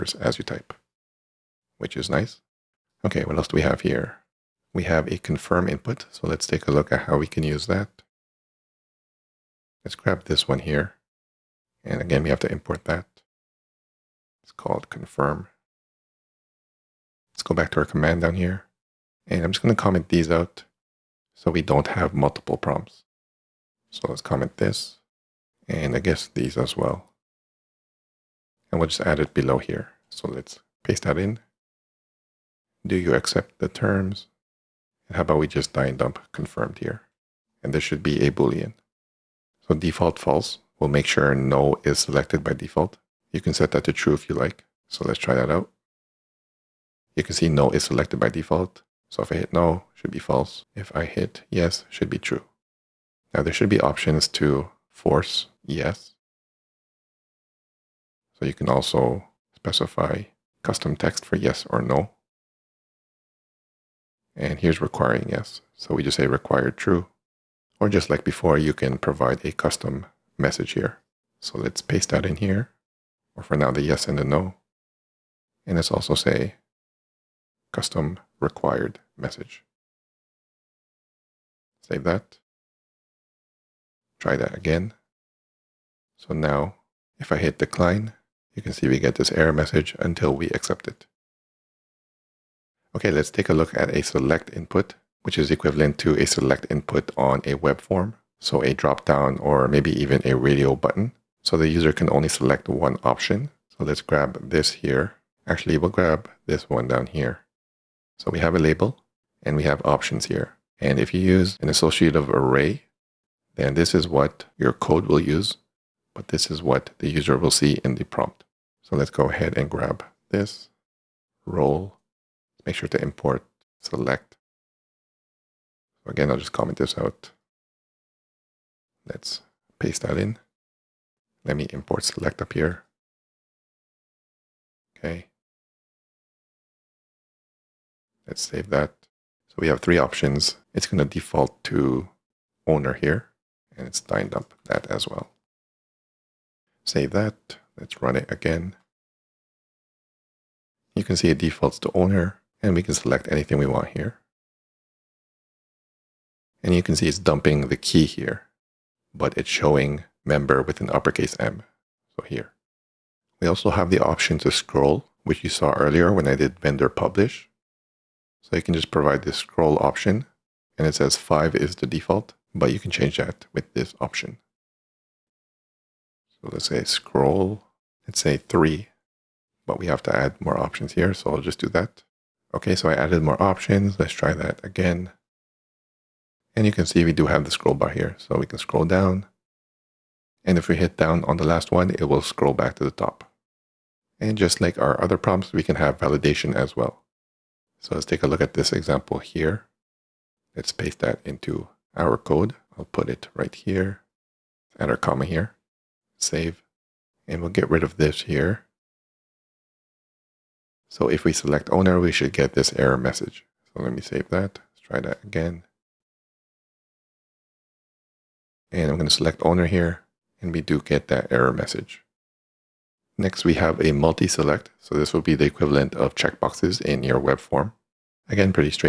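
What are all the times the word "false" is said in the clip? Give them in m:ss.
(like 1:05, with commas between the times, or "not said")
0:40, 0:50.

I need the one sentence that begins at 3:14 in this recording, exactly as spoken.
And just like our other prompts, we can have validation as well.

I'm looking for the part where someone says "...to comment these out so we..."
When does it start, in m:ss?
0:19.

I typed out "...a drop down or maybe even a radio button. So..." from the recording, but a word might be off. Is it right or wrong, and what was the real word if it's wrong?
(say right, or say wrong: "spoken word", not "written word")
right.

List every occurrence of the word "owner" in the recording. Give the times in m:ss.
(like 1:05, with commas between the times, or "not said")
2:22, 2:31, 3:31, 3:39.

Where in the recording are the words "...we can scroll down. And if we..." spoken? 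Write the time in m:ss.
3:08.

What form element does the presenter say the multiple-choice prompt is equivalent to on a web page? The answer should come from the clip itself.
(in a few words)
checkboxes.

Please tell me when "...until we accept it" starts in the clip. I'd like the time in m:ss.
1:29.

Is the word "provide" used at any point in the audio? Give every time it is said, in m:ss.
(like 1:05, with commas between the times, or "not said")
1:08, 2:48.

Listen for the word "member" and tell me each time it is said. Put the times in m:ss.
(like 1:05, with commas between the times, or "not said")
2:40.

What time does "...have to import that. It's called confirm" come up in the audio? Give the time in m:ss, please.
0:12.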